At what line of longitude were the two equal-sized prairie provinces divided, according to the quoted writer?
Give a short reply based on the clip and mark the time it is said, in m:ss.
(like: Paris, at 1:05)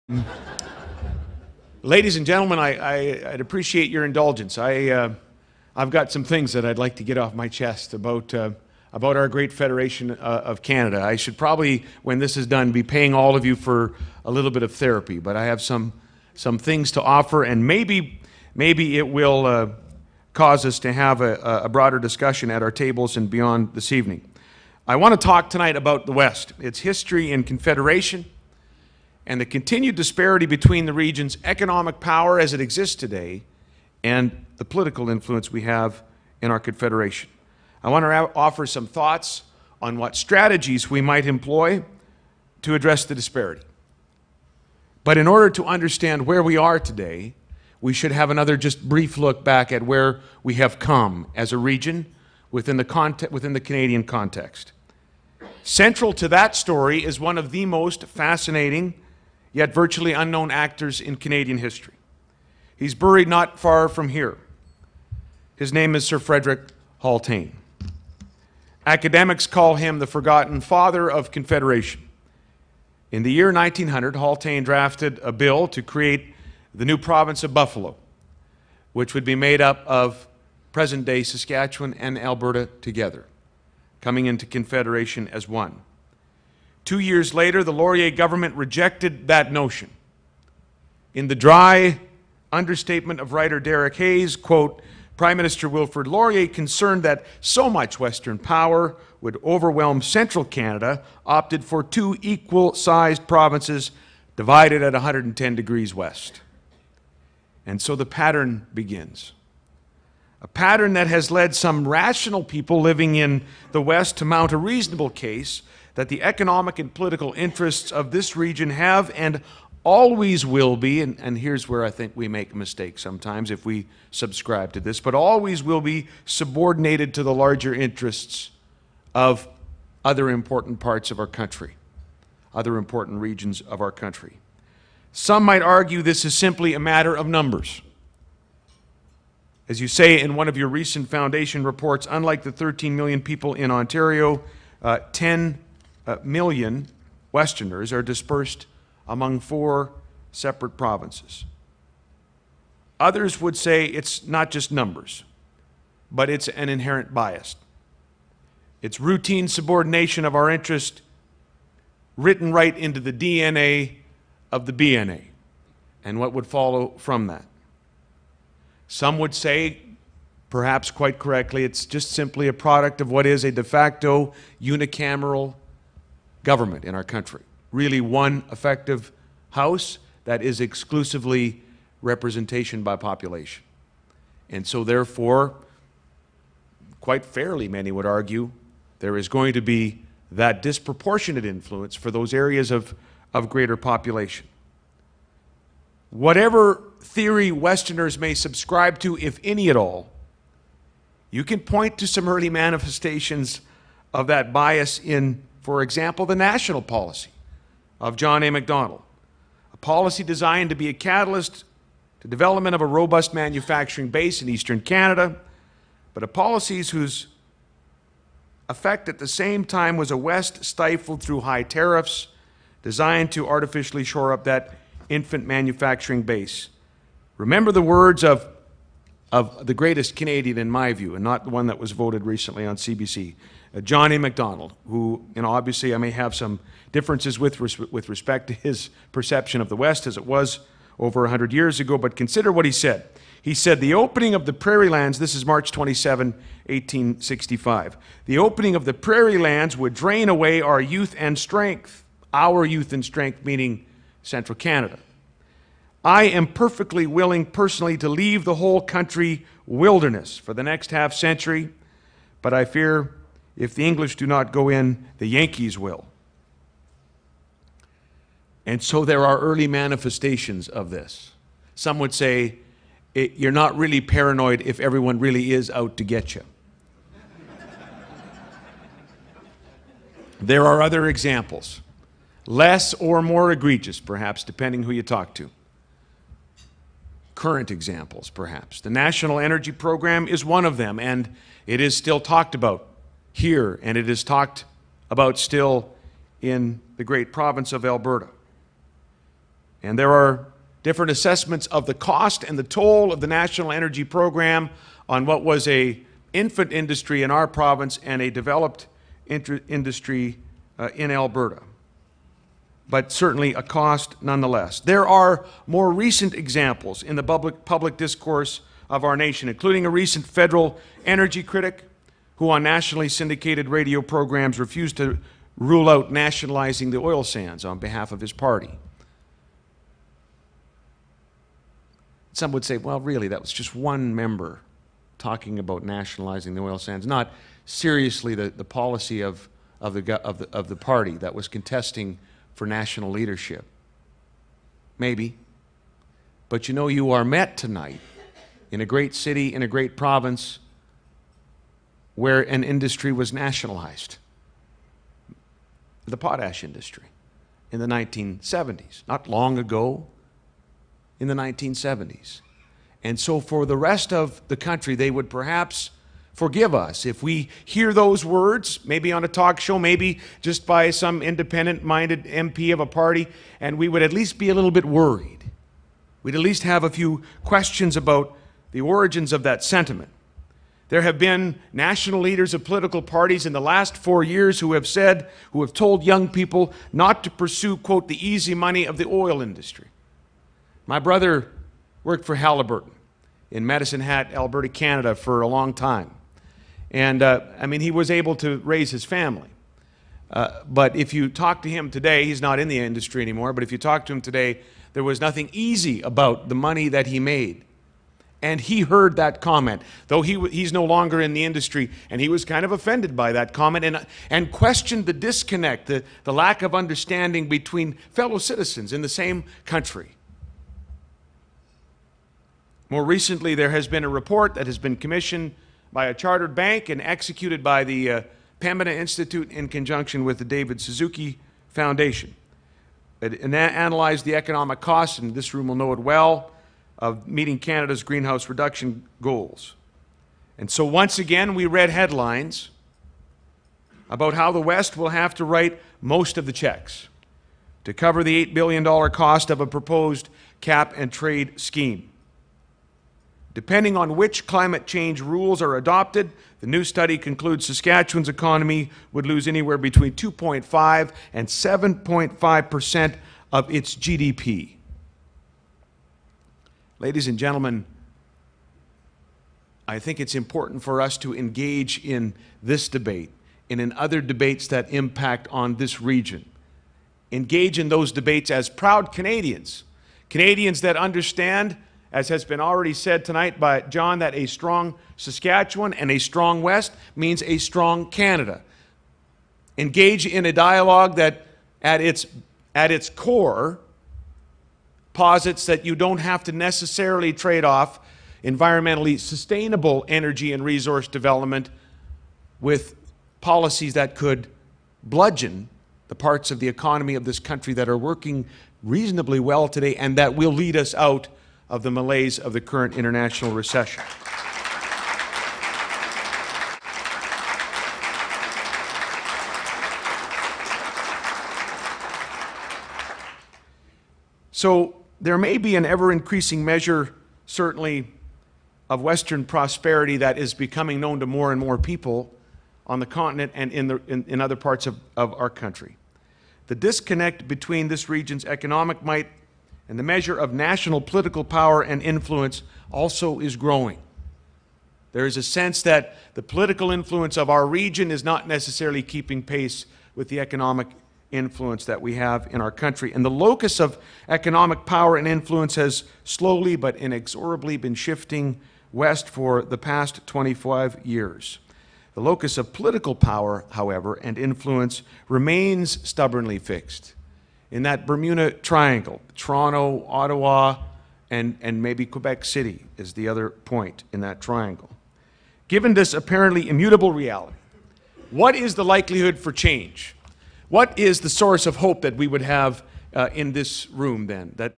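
110 degrees west, at 1:44.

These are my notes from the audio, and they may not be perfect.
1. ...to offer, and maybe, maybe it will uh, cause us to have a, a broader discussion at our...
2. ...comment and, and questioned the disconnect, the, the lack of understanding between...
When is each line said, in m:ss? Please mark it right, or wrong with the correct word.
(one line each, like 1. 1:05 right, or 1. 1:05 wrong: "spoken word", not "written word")
1. 0:16 right
2. 6:53 right.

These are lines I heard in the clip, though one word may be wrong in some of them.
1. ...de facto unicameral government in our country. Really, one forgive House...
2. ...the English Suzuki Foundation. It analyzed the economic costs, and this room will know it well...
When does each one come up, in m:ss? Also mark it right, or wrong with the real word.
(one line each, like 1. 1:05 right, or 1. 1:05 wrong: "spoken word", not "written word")
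1. 2:53 wrong: "effective", not "forgive"
2. 7:10 wrong: "David", not "English".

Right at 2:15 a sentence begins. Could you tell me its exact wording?
Some might argue this is simply a matter of numbers.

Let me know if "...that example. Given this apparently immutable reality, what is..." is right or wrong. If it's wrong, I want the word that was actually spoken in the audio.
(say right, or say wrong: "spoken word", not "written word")
wrong: "triangle", not "example".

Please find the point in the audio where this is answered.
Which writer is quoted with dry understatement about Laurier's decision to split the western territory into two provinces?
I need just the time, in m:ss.
1:33.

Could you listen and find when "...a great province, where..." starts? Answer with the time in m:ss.
5:49.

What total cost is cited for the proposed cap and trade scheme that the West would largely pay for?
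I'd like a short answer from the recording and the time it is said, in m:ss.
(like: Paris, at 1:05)
$8 billion, at 7:28.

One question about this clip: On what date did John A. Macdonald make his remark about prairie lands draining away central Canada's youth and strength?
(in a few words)
March 27, 1865.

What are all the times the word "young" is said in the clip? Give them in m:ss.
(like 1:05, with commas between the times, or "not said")
6:26.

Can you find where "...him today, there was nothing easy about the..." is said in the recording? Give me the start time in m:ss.
6:44.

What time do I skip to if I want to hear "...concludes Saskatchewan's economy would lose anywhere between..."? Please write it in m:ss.
7:37.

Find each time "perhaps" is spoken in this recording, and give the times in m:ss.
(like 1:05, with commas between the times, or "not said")
2:50, 4:43, 4:48, 6:05.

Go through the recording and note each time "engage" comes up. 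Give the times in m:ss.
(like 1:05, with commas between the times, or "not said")
7:51, 7:57, 8:09.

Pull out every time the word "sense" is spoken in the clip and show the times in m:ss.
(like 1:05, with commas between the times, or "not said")
9:05.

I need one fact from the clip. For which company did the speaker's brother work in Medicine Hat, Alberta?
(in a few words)
Halliburton.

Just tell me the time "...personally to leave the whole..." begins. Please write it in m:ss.
4:17.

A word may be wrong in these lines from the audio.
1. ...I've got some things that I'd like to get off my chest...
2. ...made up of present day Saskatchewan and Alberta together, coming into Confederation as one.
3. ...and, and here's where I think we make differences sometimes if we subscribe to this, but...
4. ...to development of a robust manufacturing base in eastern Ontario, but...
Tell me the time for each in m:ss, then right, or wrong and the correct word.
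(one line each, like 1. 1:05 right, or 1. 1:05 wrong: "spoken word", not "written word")
1. 0:05 right
2. 1:19 right
3. 2:01 wrong: "mistakes", not "differences"
4. 3:32 wrong: "Canada", not "Ontario".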